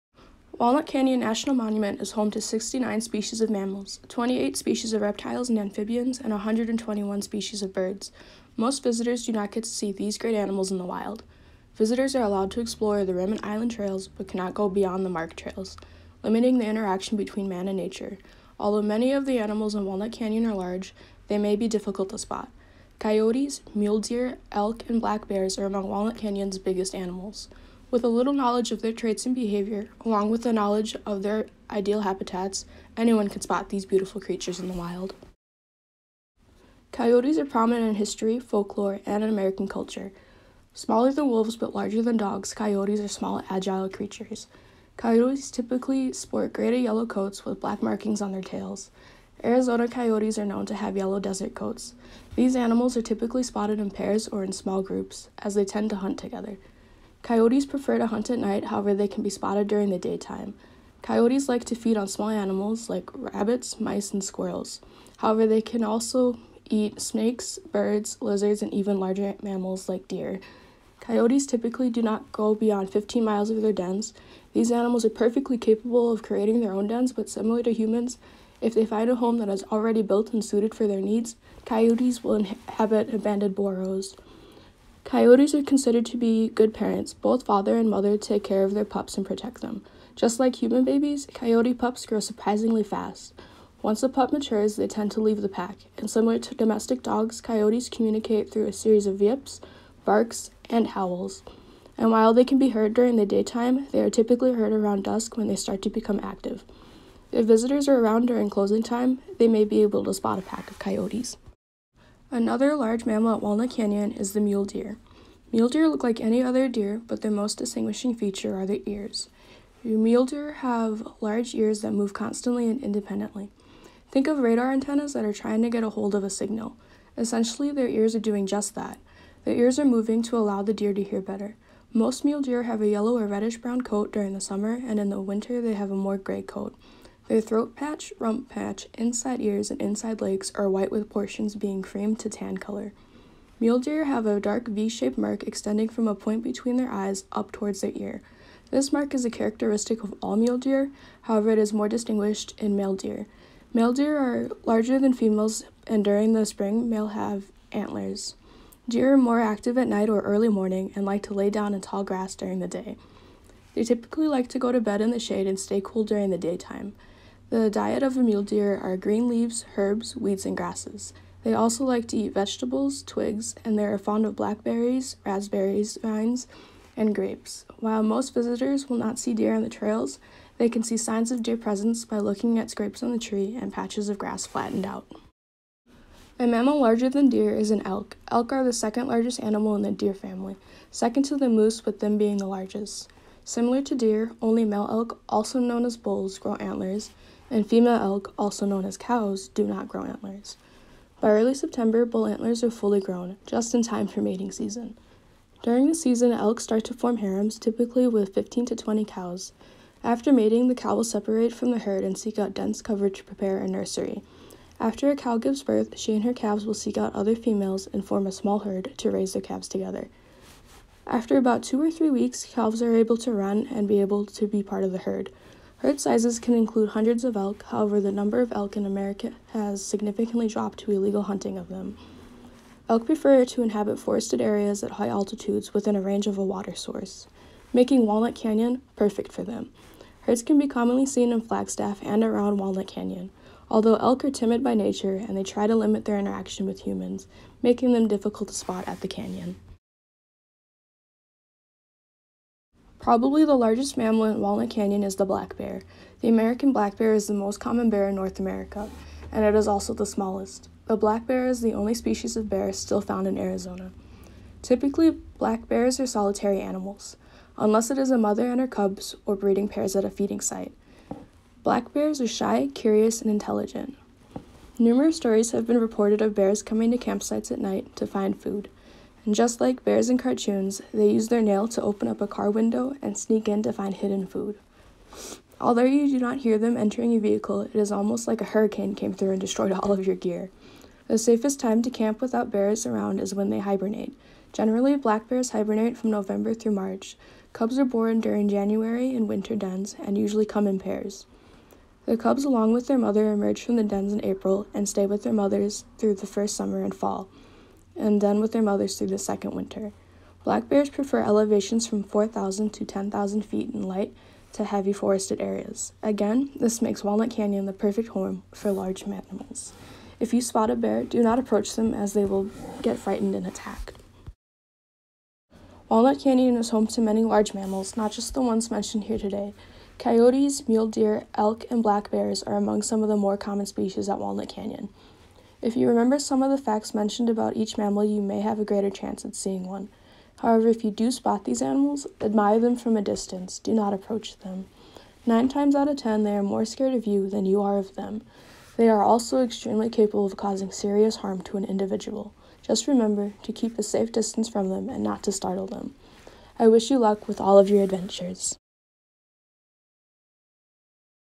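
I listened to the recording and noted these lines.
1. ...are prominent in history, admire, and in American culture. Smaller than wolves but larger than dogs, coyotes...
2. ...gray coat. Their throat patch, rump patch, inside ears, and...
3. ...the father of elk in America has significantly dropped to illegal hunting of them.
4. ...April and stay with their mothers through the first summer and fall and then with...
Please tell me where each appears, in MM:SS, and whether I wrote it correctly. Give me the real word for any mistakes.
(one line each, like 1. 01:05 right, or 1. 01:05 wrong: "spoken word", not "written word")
1. 00:37 wrong: "folklore", not "admire"
2. 02:16 right
3. 03:47 wrong: "number", not "father"
4. 05:04 right.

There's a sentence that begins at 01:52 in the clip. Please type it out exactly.
Another large mammal at Walnut Canyon is the mule deer.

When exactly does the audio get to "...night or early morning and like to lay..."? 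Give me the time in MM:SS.
02:39.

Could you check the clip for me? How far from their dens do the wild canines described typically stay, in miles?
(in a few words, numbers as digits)
15 miles.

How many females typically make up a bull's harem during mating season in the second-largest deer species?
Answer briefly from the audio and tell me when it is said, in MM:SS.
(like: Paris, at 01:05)
15 to 20, at 03:28.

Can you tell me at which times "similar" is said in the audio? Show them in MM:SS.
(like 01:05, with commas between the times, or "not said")
01:17, 01:36, 03:13.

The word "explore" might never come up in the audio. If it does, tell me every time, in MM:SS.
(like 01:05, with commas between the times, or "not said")
00:12.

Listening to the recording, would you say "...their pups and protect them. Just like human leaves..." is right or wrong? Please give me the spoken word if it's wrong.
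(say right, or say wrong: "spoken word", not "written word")
wrong: "babies", not "leaves".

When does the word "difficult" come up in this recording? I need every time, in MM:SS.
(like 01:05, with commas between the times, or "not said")
00:21, 04:08.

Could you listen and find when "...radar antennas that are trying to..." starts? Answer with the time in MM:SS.
02:04.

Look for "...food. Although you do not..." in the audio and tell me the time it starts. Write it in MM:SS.
04:44.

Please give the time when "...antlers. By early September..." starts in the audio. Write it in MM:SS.
03:20.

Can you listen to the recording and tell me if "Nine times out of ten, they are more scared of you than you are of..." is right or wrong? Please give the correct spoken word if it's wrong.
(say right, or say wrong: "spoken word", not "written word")
right.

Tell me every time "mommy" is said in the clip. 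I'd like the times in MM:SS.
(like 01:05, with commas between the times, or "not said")
not said.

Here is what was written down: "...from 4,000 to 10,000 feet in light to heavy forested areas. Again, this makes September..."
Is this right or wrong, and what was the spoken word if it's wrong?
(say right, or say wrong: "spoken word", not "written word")
wrong: "Walnut", not "September".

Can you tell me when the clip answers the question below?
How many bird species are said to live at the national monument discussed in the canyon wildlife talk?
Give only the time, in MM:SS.
00:06.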